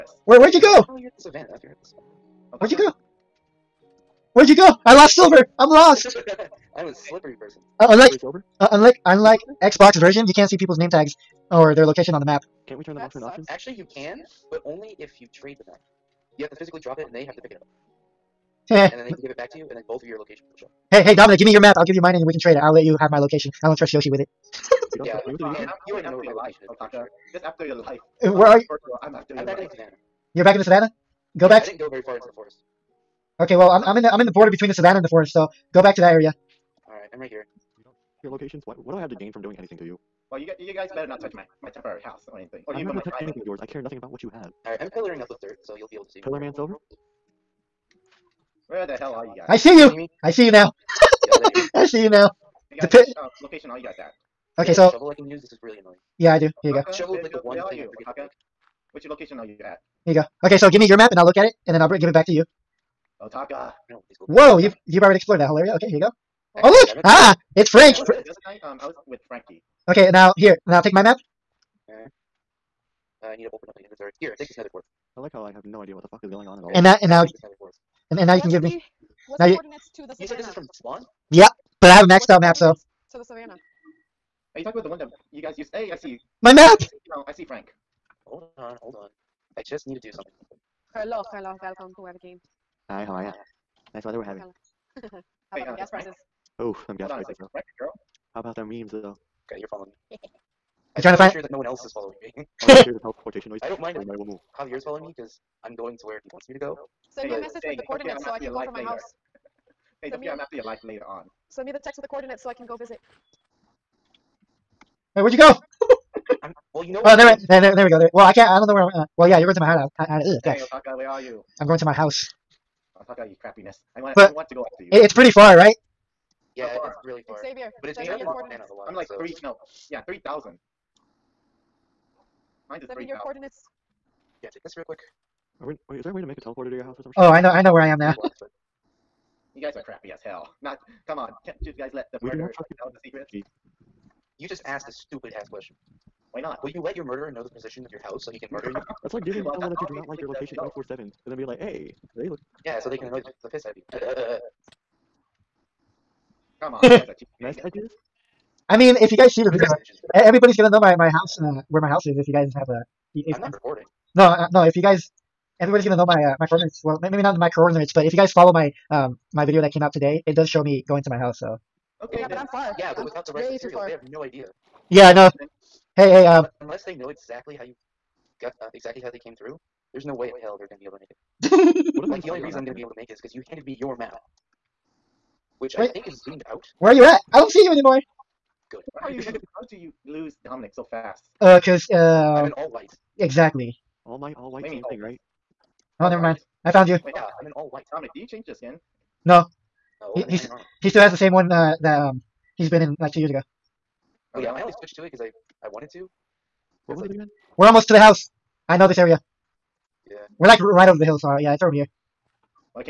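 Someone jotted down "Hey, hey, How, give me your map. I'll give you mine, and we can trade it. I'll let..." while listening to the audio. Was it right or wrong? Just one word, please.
wrong.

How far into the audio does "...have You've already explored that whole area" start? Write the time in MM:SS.
01:04.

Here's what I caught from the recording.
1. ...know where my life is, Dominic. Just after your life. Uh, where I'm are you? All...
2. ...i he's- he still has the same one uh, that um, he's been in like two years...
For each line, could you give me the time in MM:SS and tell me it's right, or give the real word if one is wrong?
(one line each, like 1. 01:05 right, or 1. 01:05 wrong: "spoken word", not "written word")
1. 00:26 wrong: "Otaka", not "Dominic"
2. 03:20 right.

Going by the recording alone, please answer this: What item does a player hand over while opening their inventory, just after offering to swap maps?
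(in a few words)
nether port.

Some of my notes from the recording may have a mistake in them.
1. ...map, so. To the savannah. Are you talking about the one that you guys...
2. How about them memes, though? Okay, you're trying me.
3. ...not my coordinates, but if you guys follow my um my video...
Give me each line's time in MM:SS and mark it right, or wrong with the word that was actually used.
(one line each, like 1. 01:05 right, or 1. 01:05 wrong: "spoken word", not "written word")
1. 01:22 right
2. 01:38 wrong: "following", not "trying"
3. 02:47 right.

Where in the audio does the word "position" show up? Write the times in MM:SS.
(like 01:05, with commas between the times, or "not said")
02:27.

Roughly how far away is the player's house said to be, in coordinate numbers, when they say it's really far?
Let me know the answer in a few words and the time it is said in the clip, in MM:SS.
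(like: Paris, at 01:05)
3000, at 02:10.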